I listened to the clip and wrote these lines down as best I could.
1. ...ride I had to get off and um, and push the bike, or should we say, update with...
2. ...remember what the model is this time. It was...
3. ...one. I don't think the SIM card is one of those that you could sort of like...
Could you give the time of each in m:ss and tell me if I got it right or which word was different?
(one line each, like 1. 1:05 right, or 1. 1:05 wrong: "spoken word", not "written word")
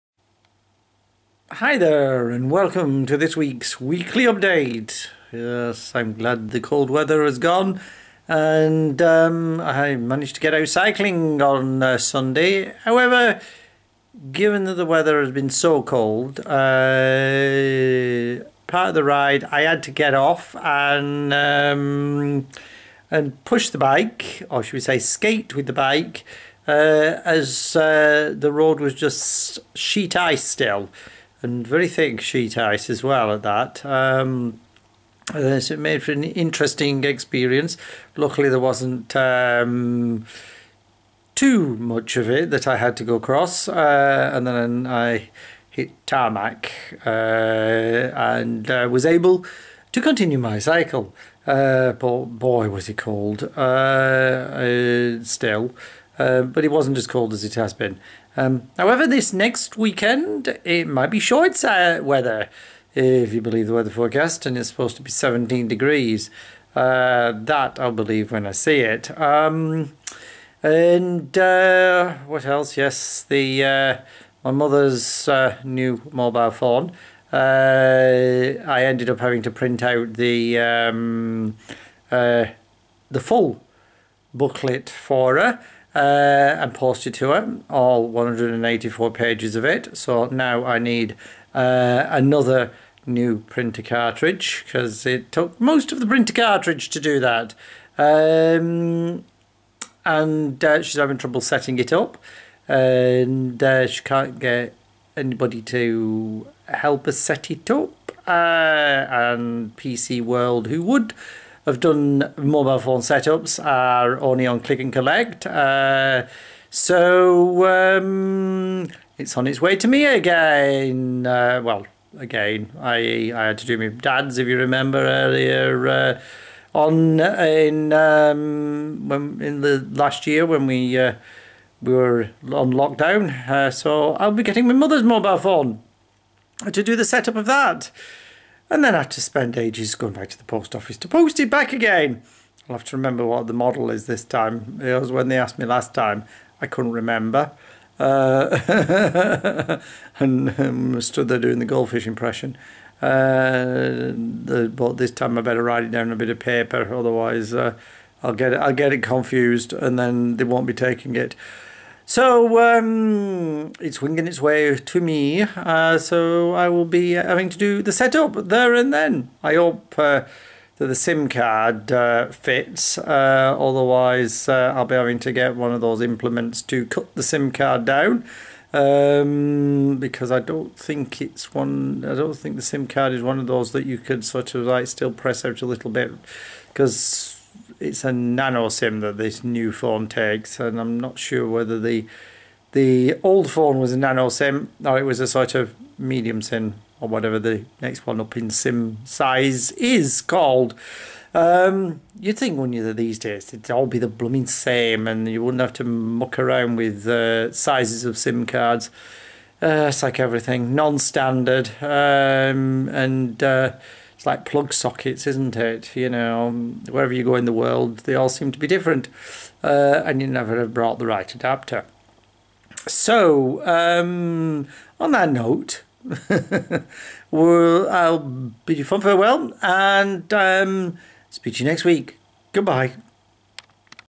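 1. 0:19 wrong: "skate", not "update"
2. 2:22 right
3. 3:01 right.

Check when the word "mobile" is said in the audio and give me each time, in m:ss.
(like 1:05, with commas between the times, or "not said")
1:16, 1:52, 2:15.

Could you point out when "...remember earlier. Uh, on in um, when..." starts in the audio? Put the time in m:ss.
2:04.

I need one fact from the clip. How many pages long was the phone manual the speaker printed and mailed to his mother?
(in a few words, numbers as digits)
184.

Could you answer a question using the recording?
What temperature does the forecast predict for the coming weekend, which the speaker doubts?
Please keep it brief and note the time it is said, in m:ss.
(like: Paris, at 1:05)
17, at 1:05.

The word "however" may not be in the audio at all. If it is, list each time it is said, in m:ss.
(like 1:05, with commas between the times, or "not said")
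0:12, 0:58.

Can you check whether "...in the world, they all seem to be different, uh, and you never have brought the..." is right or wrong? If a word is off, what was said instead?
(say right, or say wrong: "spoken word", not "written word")
right.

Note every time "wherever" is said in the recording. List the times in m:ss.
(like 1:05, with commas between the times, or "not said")
3:36.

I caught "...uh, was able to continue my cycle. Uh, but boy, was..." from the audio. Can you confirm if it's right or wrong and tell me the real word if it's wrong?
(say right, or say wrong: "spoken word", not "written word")
right.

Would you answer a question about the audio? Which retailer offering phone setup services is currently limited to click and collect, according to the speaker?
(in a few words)
PC World.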